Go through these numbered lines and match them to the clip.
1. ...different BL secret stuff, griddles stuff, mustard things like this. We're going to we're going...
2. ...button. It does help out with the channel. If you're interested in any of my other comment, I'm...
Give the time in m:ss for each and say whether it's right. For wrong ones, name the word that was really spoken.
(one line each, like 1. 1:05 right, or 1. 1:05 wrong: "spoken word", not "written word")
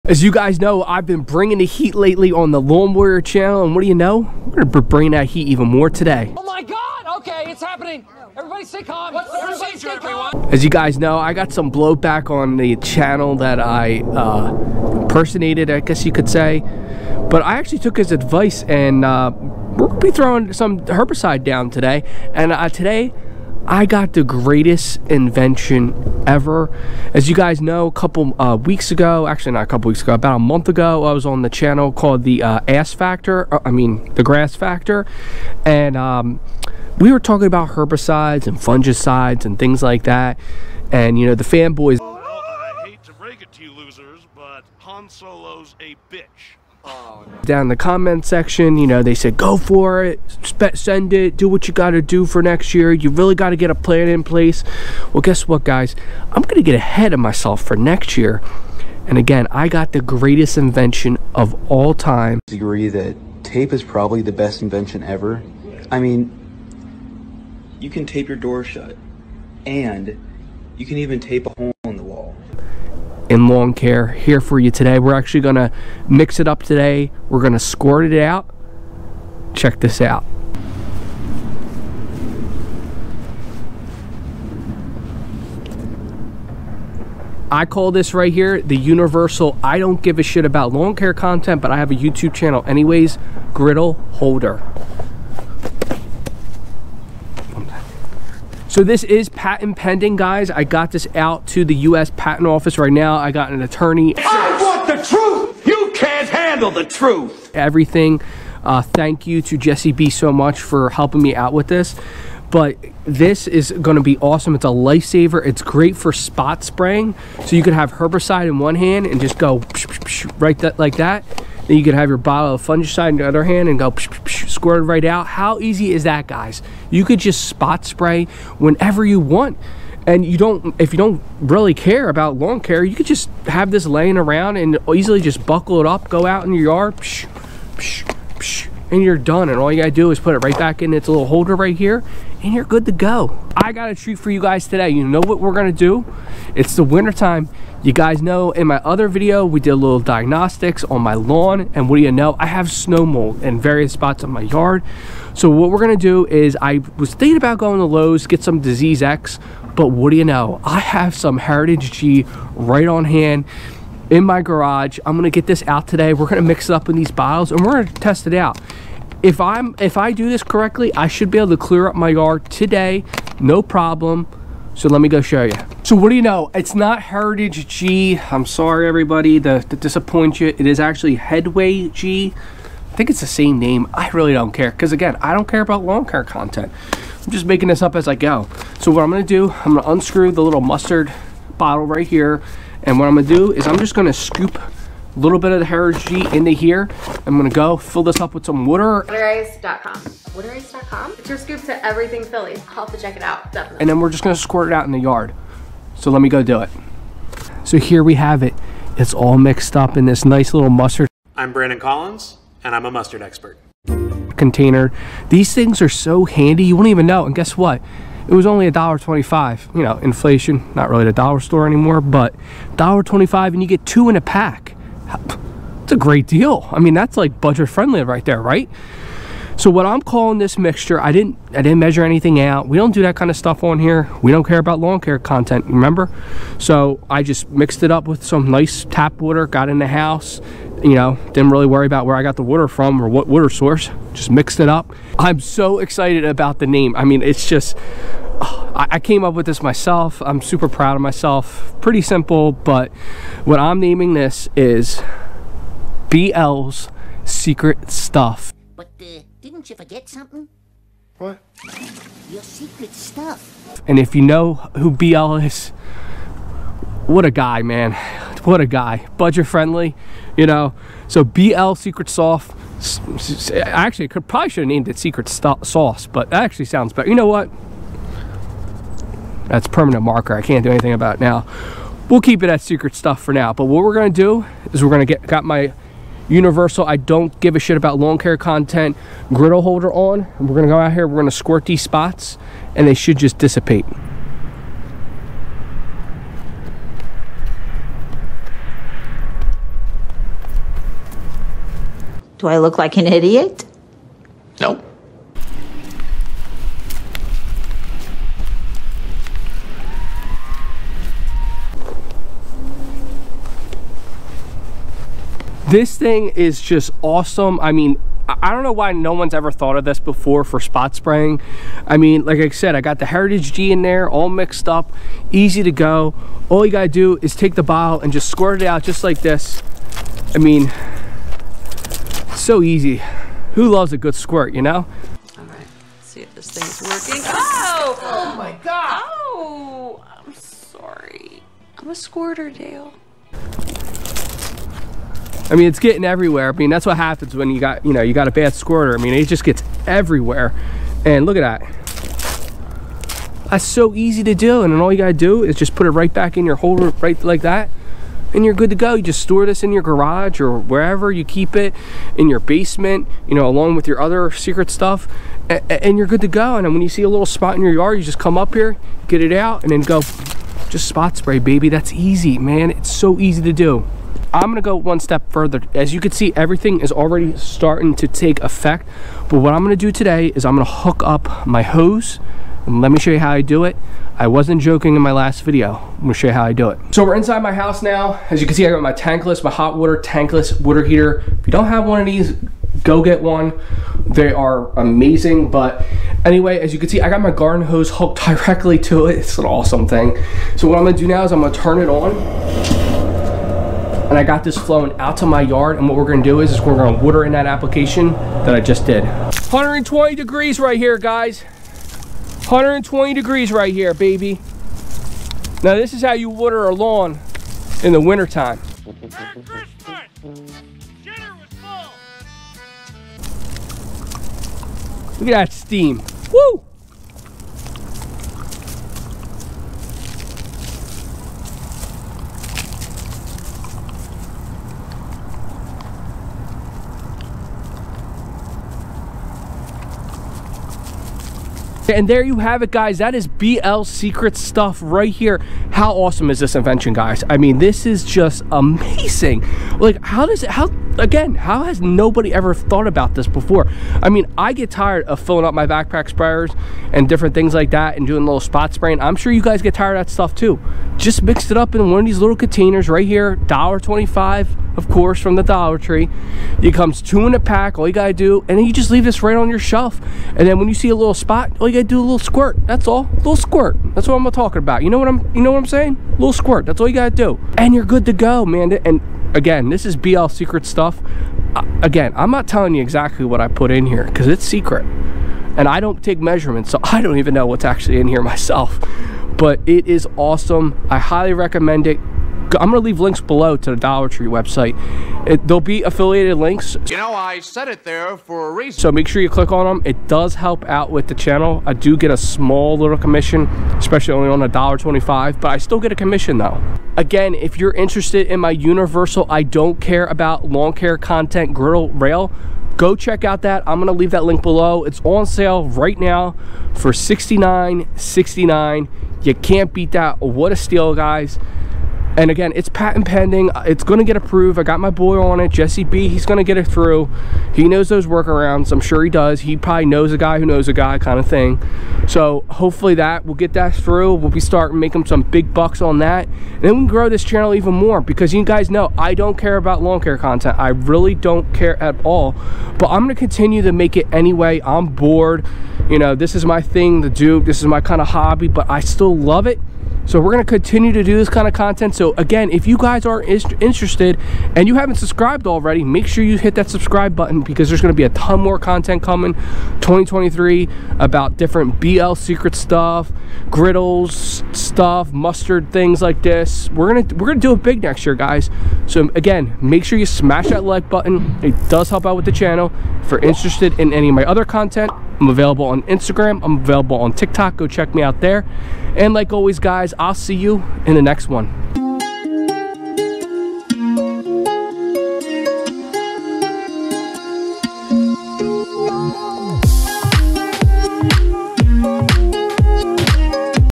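1. 9:21 right
2. 9:30 wrong: "content", not "comment".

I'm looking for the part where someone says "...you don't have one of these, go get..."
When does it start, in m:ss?
6:31.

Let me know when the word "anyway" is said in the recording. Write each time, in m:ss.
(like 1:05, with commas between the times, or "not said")
1:32, 6:36, 9:04.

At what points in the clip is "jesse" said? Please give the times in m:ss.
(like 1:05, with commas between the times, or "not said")
1:49, 8:45.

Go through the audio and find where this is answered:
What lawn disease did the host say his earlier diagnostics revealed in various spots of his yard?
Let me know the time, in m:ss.
2:32.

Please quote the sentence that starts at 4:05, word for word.
I'm so excited about the name.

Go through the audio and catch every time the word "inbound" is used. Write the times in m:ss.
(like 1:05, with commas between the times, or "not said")
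not said.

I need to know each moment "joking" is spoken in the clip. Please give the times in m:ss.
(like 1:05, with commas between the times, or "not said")
6:24.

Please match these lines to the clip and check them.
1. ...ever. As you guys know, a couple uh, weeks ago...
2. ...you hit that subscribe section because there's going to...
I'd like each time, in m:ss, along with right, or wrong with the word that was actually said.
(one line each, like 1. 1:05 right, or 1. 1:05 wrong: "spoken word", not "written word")
1. 0:26 right
2. 9:16 wrong: "button", not "section".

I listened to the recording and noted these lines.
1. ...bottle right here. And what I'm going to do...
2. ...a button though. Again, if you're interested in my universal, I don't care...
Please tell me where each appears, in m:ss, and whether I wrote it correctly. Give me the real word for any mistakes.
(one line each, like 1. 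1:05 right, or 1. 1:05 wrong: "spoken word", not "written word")
1. 3:11 right
2. 8:25 wrong: "commission", not "button".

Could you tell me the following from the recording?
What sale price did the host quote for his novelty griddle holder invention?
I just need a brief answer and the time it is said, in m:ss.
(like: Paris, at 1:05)
$69.69, at 8:36.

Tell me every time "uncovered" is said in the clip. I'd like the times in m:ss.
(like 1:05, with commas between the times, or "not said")
not said.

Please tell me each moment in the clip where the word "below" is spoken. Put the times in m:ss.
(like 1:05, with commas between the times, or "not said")
8:13, 8:34.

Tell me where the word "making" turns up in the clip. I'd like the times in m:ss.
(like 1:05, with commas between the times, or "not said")
3:07, 8:54.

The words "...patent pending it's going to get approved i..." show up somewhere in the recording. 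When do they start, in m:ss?
8:42.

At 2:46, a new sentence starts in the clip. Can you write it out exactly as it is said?
We're gonna mix it up in these bottles and we're gonna test it out.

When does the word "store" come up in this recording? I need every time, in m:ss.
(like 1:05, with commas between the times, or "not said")
3:41, 5:59.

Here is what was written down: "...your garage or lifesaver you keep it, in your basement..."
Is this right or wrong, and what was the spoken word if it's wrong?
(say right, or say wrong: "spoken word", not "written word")
wrong: "wherever", not "lifesaver".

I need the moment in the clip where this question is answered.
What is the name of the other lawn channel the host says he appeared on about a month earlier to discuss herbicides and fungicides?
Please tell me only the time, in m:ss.
0:34.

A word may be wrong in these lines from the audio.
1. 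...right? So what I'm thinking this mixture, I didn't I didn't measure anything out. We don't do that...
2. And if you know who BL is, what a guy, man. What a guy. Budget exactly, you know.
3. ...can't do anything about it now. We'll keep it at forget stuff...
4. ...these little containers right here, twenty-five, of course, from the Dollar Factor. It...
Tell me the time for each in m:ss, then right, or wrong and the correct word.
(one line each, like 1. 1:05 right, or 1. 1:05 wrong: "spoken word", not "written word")
1. 3:48 wrong: "calling", not "thinking"
2. 4:23 wrong: "friendly", not "exactly"
3. 4:40 wrong: "secret", not "forget"
4. 7:42 wrong: "Tree", not "Factor".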